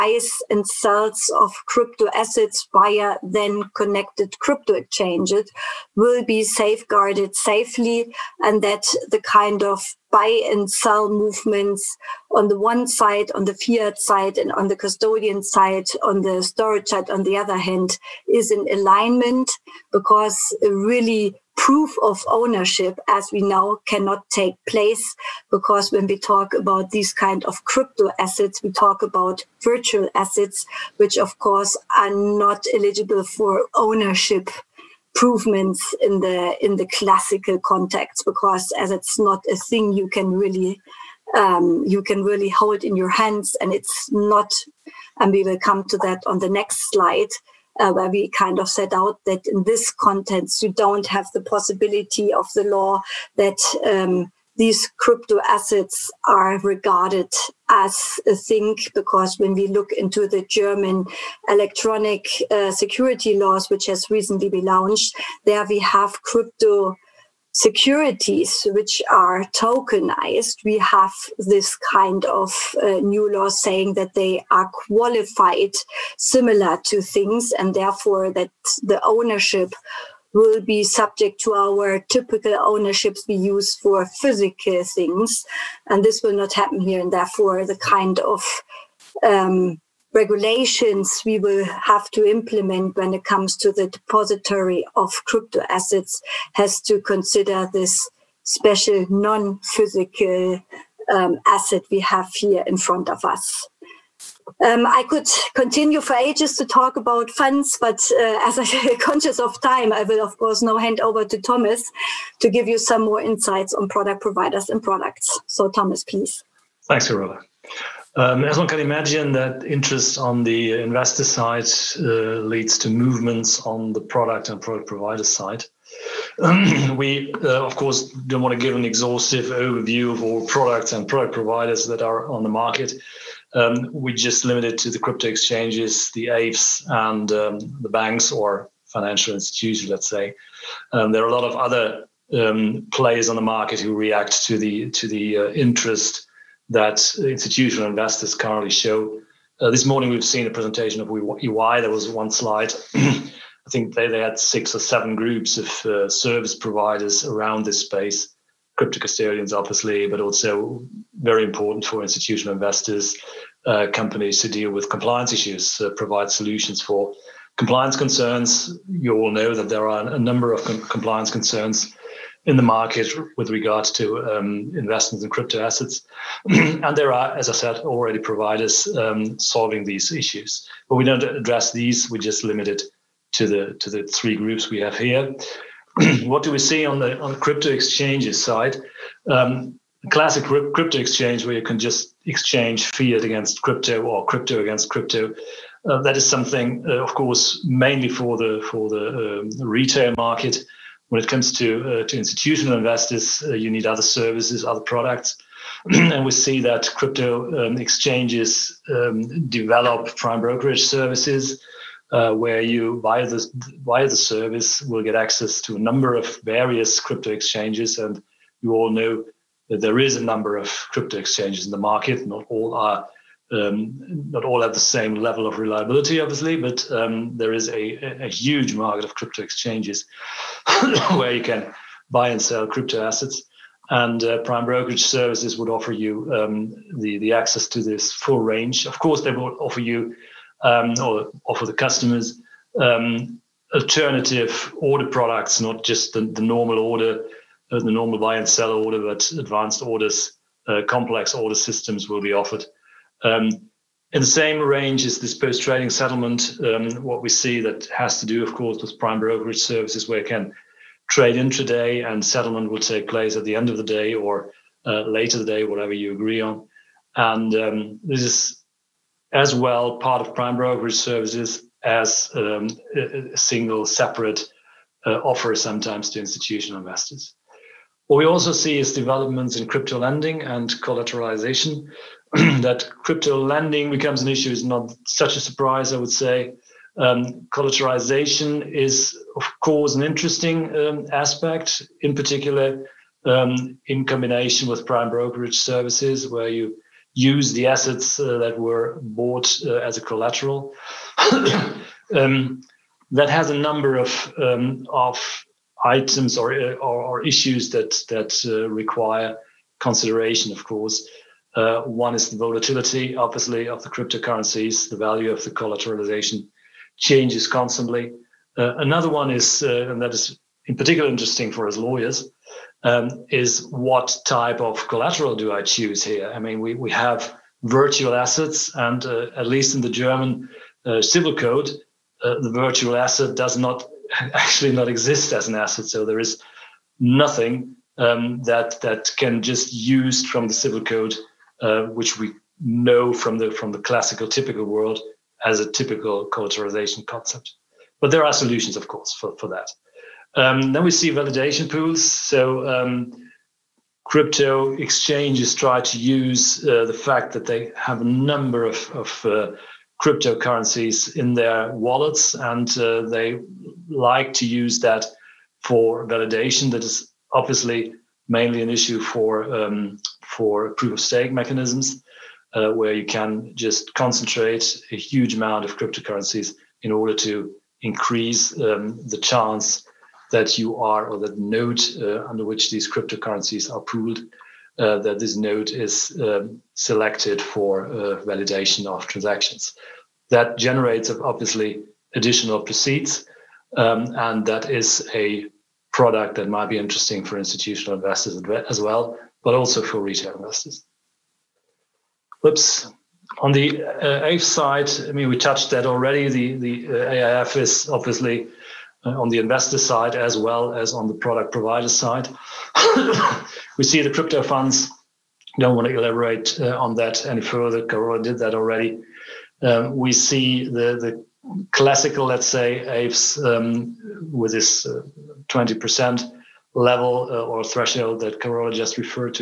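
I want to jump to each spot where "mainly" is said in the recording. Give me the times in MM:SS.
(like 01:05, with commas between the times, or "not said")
03:17, 06:08.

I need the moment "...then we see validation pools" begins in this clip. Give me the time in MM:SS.
05:50.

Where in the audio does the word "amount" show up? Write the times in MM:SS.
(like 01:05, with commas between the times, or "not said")
06:15.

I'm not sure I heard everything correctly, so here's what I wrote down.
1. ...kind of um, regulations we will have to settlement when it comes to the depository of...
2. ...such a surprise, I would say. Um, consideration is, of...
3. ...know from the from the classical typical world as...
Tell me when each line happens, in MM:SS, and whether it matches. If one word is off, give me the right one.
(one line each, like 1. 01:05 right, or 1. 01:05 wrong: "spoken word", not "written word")
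1. 01:27 wrong: "implement", not "settlement"
2. 04:45 wrong: "collateralization", not "consideration"
3. 05:42 right.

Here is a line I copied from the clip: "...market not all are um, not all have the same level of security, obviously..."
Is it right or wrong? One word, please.
wrong.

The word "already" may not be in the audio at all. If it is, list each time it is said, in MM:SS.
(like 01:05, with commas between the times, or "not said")
02:57, 06:45, 06:58.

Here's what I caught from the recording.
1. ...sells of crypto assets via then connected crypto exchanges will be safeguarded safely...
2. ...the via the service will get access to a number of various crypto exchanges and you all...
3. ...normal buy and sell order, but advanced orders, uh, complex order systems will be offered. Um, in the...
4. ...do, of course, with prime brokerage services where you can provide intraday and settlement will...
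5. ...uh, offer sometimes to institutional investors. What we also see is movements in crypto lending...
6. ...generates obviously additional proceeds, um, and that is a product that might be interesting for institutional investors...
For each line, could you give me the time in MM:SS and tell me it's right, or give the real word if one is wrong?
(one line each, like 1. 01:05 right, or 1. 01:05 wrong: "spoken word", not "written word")
1. 00:00 right
2. 03:33 right
3. 04:07 right
4. 04:18 wrong: "trade", not "provide"
5. 04:35 wrong: "developments", not "movements"
6. 06:30 right.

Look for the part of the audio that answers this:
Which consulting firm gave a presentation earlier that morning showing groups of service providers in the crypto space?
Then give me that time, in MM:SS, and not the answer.
02:31.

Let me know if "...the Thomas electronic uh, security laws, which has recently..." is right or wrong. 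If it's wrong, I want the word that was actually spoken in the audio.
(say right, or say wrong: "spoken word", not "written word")
wrong: "German", not "Thomas".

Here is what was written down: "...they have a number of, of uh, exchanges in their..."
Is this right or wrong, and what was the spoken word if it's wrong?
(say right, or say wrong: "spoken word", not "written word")
wrong: "cryptocurrencies", not "exchanges".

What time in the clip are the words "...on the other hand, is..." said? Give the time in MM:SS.
00:17.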